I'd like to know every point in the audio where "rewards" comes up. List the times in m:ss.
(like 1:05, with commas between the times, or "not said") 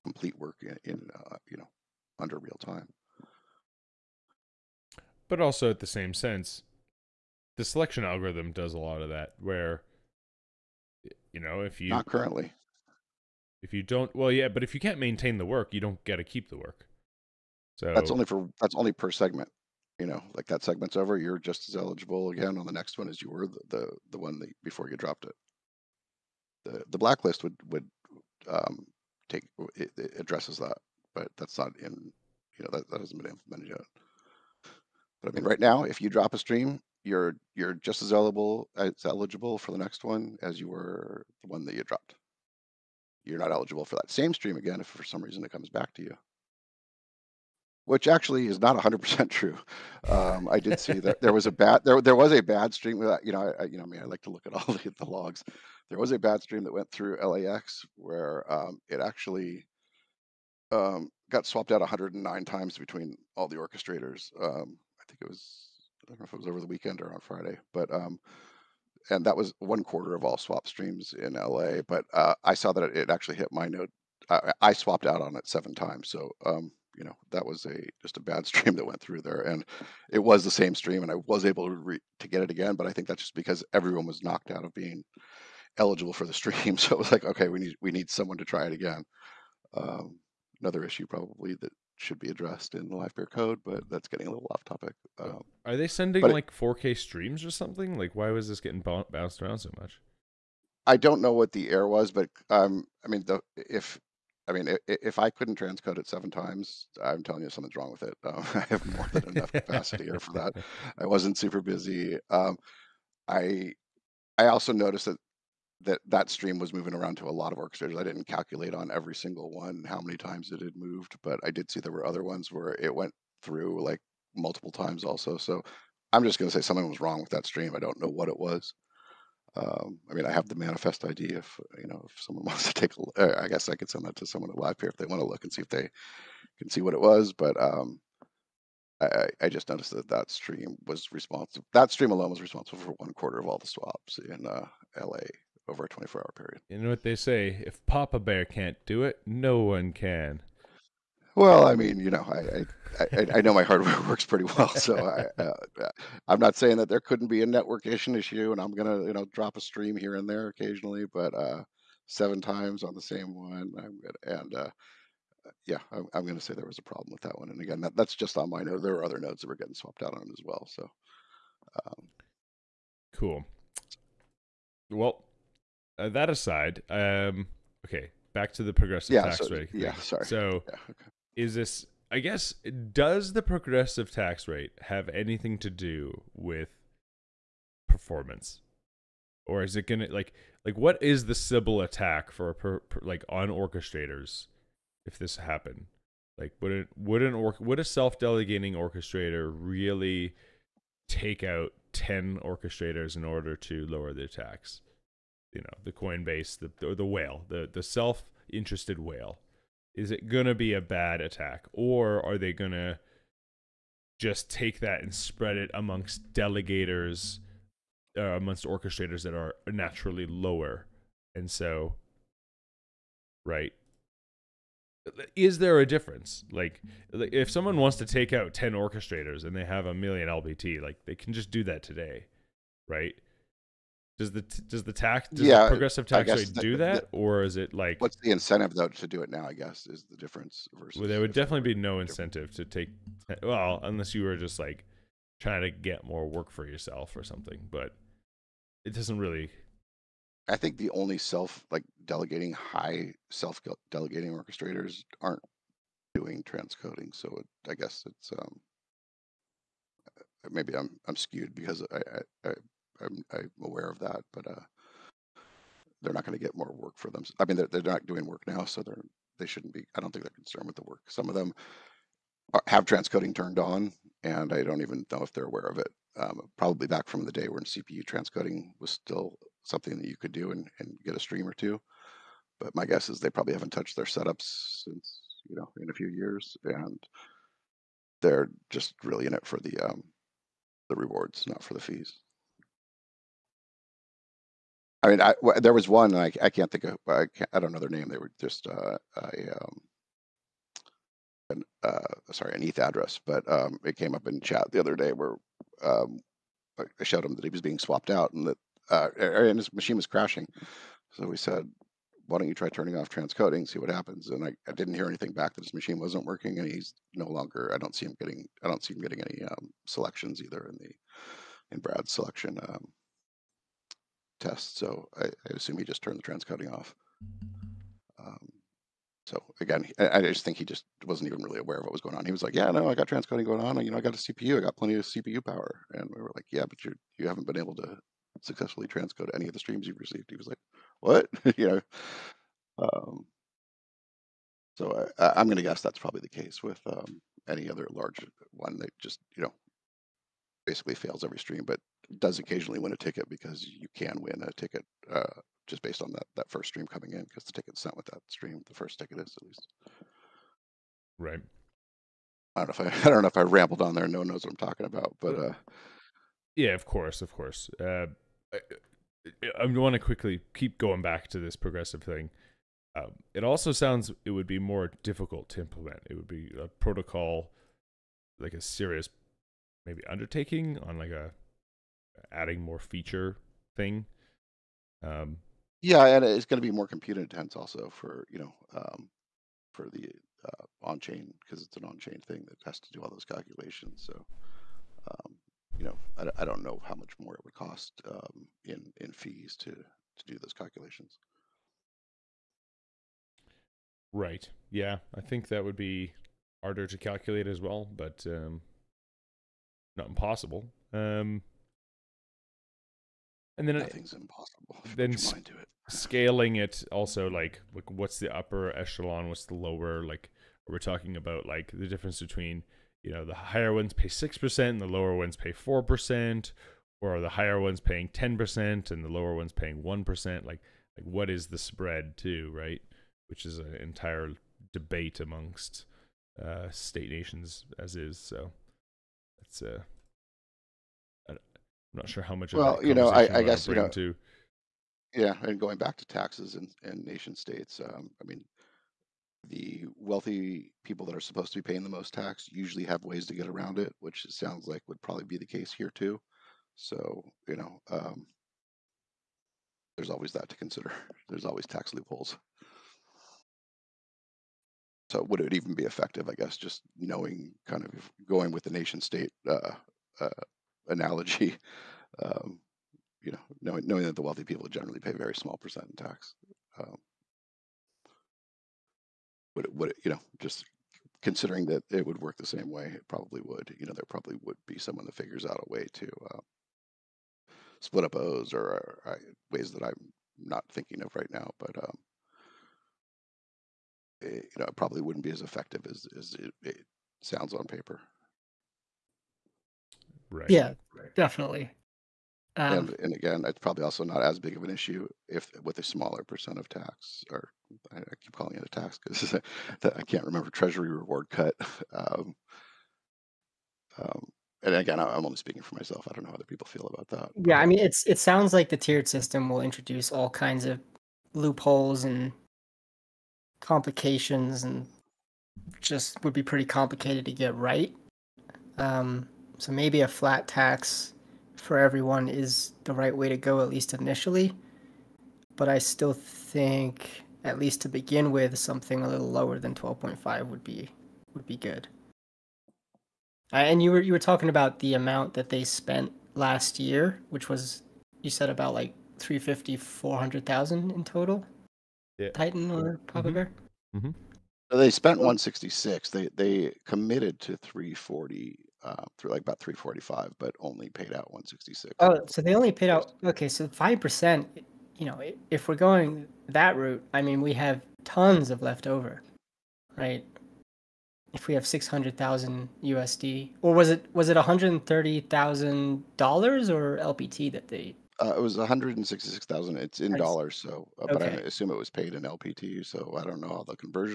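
4:50, 8:30.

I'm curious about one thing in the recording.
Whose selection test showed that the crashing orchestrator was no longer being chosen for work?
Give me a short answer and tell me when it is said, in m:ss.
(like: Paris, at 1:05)
Brad, at 5:21.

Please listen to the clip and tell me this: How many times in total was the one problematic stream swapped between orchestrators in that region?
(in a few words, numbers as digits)
109.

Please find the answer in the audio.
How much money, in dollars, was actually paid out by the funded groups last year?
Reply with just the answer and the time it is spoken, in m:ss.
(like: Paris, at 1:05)
166,000, at 9:38.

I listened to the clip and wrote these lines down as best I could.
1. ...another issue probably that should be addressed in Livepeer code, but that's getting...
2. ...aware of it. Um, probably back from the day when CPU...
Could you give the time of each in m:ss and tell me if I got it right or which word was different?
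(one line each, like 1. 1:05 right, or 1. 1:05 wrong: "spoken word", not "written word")
1. 1:30 right
2. 4:35 right.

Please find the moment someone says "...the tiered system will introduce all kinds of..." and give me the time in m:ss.
8:38.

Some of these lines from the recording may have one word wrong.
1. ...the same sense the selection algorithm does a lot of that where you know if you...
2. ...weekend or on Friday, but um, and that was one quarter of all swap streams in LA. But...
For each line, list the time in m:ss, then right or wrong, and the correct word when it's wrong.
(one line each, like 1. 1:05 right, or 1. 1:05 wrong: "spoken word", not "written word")
1. 0:05 right
2. 1:06 right.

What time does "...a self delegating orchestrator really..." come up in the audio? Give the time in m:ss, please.
3:17.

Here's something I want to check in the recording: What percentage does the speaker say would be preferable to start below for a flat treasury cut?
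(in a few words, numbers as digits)
12.5.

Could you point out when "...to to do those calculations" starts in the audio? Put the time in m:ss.
6:39.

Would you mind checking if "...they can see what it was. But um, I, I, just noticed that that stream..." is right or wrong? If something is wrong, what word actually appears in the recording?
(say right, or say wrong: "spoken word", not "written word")
right.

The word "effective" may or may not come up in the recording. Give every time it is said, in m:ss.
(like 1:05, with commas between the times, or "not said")
7:45, 8:15.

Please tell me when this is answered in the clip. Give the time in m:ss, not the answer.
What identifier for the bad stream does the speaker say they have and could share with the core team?
2:10.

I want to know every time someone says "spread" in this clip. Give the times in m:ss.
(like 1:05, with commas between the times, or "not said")
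3:35, 7:11.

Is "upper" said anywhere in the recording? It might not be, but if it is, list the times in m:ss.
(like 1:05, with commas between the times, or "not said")
6:58.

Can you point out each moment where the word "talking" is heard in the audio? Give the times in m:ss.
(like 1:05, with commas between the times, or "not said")
6:04, 7:00, 9:04.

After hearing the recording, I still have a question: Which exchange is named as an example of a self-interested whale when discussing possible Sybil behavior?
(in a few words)
Coinbase.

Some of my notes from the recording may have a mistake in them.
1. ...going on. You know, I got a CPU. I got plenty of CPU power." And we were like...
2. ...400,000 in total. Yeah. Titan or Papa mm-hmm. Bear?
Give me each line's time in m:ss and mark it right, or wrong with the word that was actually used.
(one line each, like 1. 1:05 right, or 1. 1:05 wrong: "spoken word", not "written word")
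1. 5:33 right
2. 9:09 right.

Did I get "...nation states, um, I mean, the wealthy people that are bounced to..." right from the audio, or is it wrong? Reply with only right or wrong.
wrong.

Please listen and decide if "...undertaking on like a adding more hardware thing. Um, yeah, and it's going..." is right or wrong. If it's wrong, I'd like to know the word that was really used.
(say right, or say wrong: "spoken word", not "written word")
wrong: "feature", not "hardware".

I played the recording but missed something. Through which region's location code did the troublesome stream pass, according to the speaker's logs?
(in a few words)
LAX.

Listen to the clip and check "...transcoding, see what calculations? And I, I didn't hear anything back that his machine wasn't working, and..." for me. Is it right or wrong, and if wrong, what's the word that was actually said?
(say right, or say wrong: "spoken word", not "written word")
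wrong: "happens", not "calculations".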